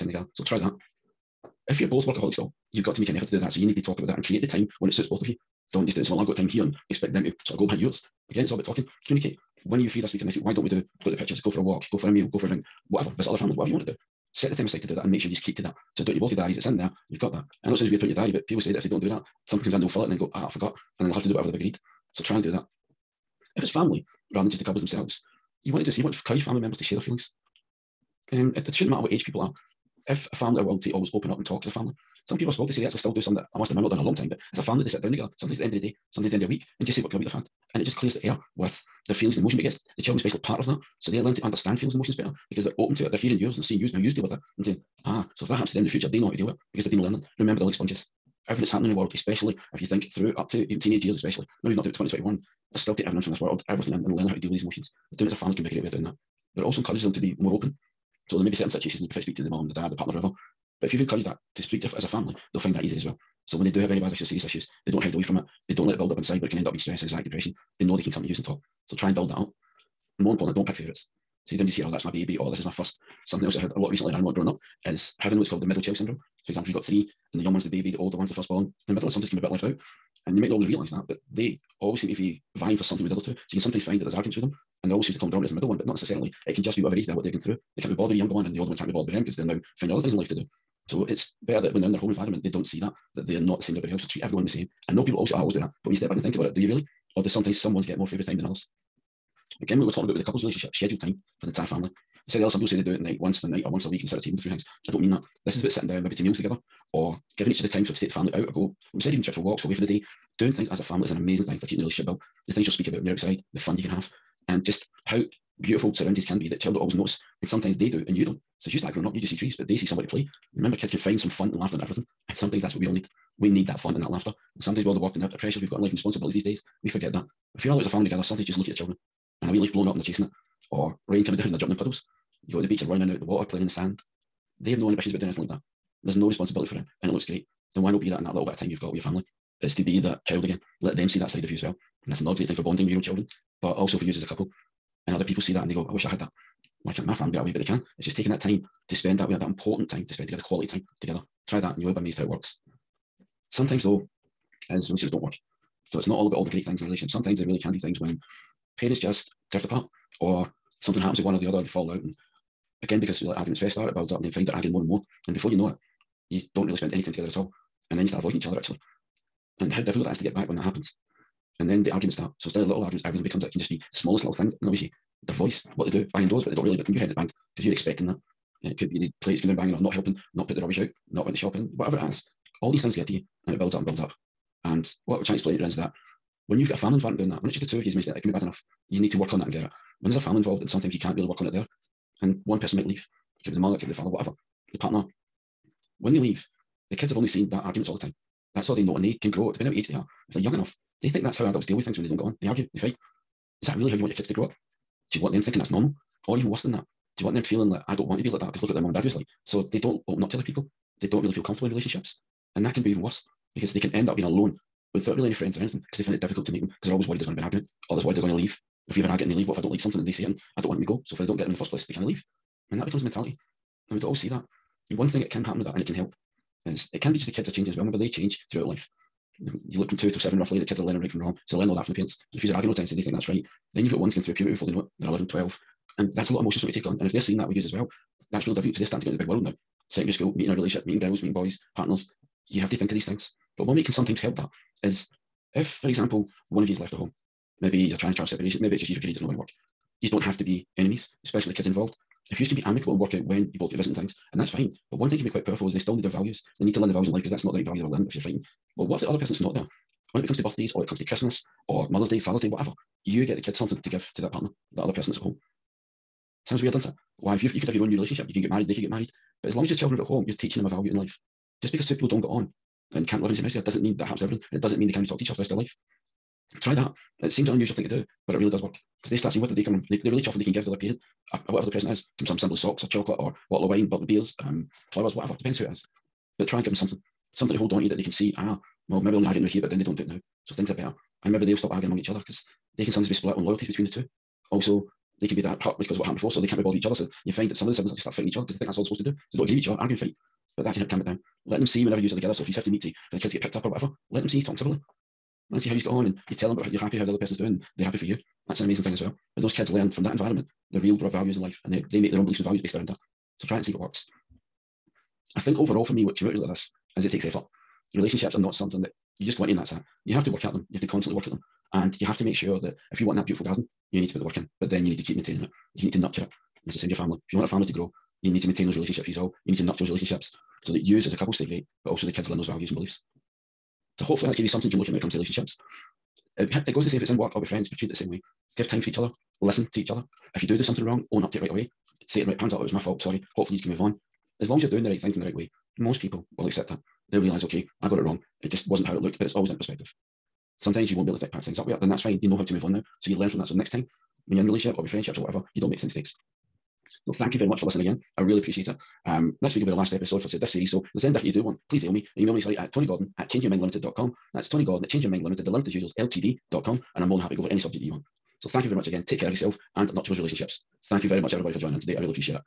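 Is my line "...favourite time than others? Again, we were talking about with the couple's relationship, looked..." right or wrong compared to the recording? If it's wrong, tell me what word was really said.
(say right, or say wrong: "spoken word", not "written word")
wrong: "scheduled", not "looked".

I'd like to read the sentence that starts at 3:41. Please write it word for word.
So if I don't get them in the first place, they can't leave.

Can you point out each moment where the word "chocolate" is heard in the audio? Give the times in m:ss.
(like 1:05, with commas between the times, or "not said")
4:42.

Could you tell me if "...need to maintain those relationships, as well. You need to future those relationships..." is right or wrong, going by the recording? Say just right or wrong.
wrong.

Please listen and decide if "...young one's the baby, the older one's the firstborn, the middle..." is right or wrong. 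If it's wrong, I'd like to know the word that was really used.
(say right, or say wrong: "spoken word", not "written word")
right.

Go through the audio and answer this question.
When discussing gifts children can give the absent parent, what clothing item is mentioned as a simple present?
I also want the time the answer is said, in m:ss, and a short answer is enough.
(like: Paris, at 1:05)
Socks, at 4:42.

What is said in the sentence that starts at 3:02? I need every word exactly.
All these things get to you and it builds up and builds up.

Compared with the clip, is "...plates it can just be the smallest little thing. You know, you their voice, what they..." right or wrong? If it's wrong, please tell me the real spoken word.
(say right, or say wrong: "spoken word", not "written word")
wrong: "becomes", not "plates".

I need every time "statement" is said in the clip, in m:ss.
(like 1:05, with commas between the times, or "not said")
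not said.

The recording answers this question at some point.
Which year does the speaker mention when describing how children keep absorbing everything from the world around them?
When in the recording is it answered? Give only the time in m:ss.
0:51.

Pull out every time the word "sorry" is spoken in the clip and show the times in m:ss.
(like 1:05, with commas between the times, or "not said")
5:43, 6:02.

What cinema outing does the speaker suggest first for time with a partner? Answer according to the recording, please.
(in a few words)
Go to the pictures.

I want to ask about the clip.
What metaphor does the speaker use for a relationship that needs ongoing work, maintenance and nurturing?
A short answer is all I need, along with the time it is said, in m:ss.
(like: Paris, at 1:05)
Beautiful garden, at 5:23.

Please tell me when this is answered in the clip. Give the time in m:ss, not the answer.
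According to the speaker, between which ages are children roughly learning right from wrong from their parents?
3:49.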